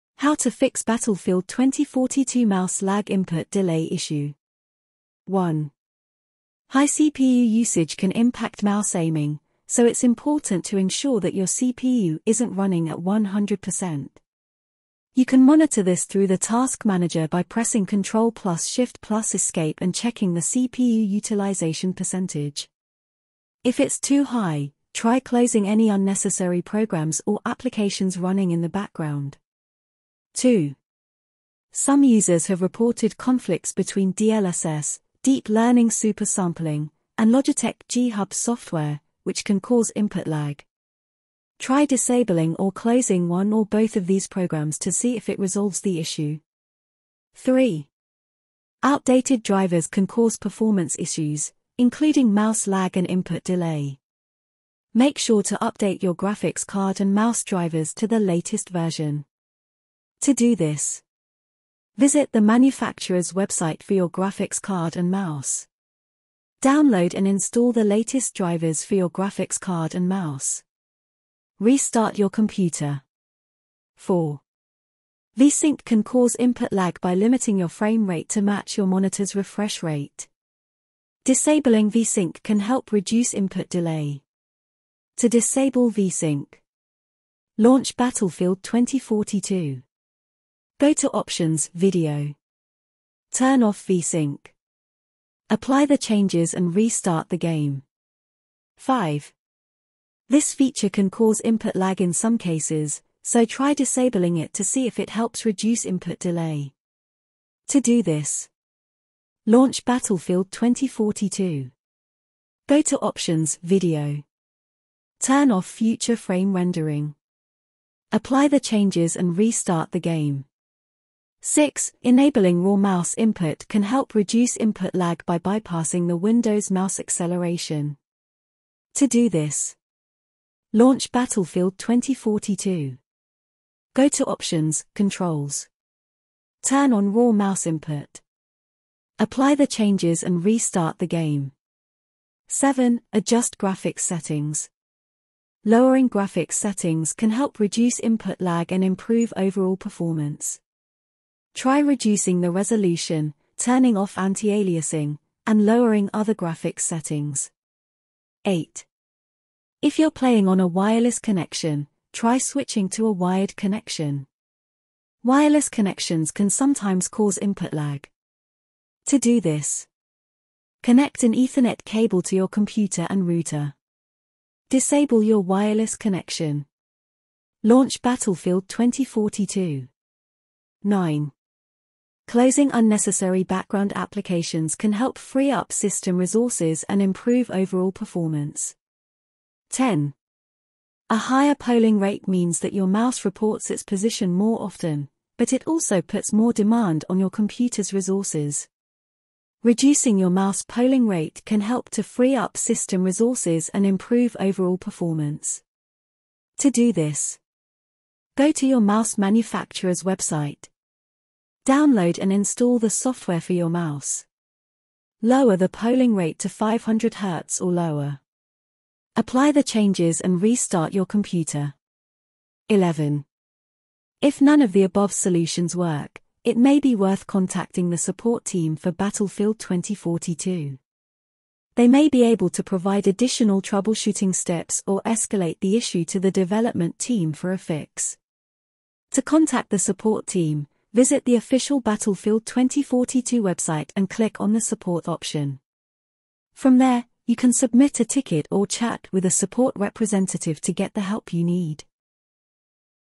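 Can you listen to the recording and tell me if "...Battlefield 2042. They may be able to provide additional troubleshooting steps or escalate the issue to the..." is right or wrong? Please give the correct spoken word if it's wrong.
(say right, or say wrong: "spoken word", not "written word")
right.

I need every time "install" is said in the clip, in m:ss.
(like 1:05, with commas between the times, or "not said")
1:07, 3:32.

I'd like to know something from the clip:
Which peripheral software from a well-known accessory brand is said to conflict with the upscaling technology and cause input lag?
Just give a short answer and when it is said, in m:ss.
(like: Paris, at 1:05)
Logitech G Hub, at 0:37.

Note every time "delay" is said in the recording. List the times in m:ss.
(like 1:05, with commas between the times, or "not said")
0:03, 0:53, 1:23, 1:46.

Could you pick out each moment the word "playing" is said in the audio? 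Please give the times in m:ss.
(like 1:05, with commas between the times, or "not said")
2:40.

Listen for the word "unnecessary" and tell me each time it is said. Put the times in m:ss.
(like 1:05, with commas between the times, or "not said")
0:25, 3:02.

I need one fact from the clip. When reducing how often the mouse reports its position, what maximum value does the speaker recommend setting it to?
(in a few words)
500 Hz.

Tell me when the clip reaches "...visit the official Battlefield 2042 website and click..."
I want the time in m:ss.
4:00.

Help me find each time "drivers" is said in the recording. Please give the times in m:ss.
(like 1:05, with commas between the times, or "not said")
0:49, 0:57, 1:08.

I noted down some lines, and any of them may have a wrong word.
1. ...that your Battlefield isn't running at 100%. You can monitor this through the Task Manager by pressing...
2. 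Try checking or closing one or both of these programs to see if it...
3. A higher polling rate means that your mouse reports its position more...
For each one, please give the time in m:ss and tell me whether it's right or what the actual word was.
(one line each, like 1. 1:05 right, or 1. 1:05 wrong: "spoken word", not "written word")
1. 0:11 wrong: "CPU", not "Battlefield"
2. 0:41 wrong: "disabling", not "checking"
3. 3:11 right.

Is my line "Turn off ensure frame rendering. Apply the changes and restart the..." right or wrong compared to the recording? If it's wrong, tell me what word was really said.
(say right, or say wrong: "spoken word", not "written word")
wrong: "future", not "ensure".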